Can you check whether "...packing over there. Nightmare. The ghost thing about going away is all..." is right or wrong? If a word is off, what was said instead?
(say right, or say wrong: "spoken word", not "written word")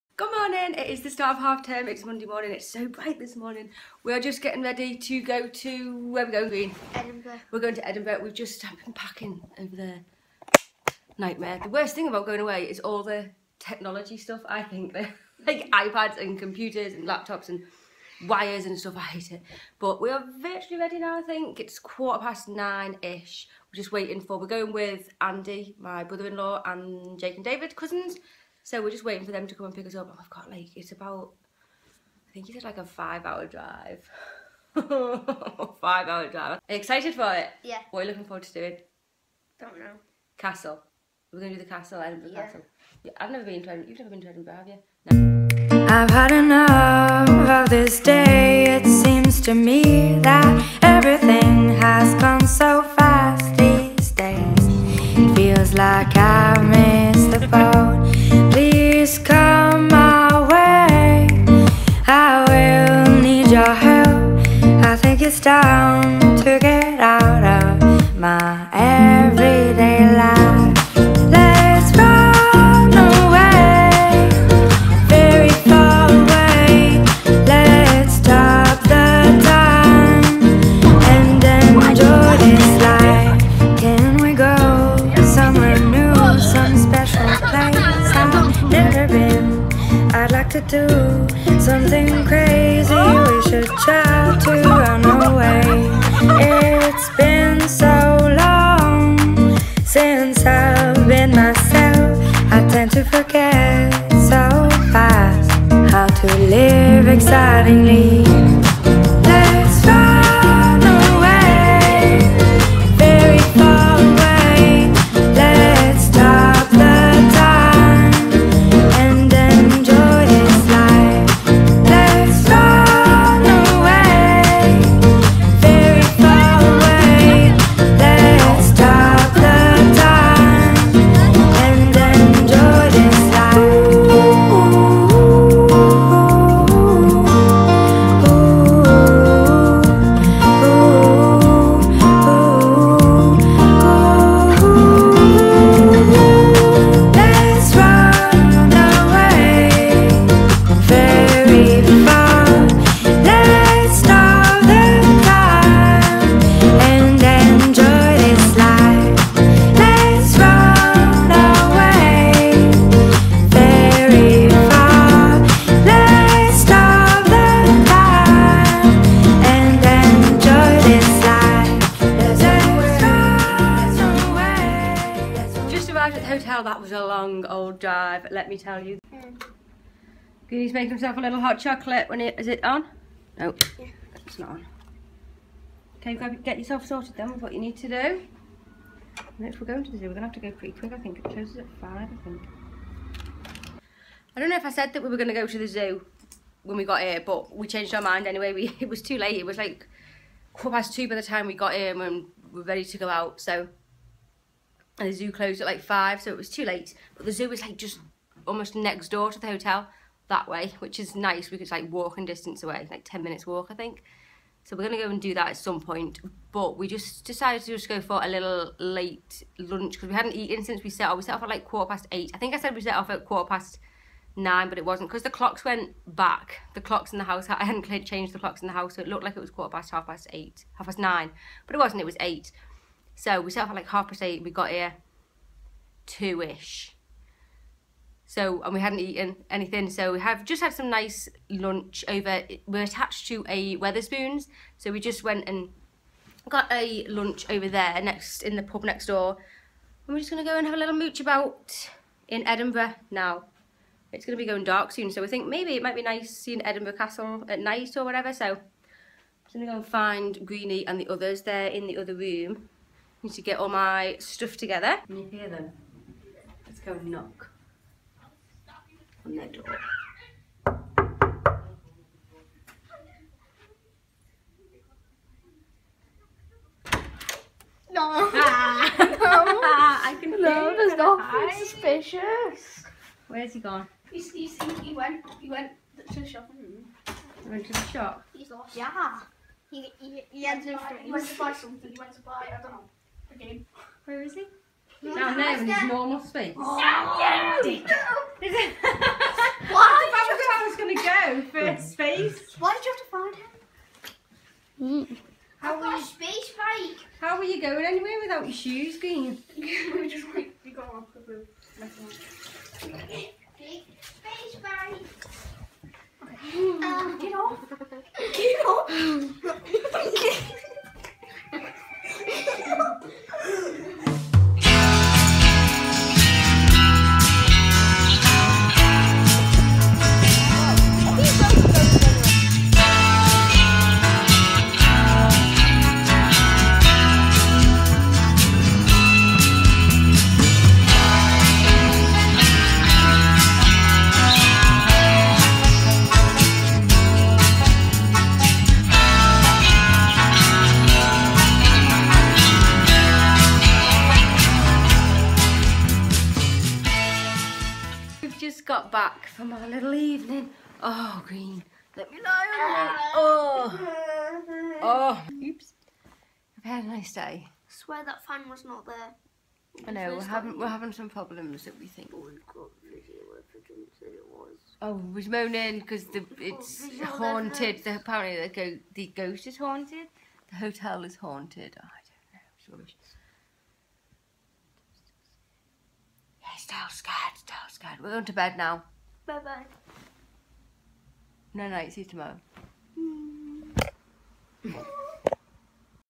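wrong: "worst", not "ghost".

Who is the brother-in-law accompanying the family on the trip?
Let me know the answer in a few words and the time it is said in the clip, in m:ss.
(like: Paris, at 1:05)
Andy, at 0:25.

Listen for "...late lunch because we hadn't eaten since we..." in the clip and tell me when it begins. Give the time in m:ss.
3:38.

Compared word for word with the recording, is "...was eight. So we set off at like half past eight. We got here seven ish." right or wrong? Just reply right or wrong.
wrong.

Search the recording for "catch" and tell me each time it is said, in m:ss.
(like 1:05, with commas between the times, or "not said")
not said.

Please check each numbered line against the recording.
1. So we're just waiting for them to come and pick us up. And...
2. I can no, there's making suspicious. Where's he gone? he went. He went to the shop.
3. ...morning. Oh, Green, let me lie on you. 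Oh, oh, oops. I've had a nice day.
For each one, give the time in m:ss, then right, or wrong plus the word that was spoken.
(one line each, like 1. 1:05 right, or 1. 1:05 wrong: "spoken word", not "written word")
1. 0:28 right
2. 4:39 wrong: "nothing", not "making"
3. 5:59 wrong: "evening", not "morning".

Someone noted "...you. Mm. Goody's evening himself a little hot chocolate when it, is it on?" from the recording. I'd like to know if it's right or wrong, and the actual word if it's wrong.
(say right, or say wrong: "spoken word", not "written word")
wrong: "making", not "evening".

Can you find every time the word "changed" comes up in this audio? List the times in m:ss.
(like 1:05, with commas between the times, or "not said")
3:17, 3:48.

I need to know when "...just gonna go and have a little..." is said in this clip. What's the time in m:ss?
4:10.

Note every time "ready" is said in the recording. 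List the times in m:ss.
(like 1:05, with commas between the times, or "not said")
0:04, 0:20, 3:22.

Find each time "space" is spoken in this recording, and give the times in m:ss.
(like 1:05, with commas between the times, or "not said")
4:56, 5:01, 5:06.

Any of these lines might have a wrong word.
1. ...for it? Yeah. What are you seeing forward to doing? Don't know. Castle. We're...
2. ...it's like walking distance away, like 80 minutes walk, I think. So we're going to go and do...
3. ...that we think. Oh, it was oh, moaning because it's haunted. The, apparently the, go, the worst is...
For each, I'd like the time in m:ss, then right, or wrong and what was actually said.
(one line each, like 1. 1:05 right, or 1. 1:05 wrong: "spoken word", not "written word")
1. 0:37 wrong: "looking", not "seeing"
2. 3:31 wrong: "10", not "80"
3. 6:11 wrong: "ghost", not "worst".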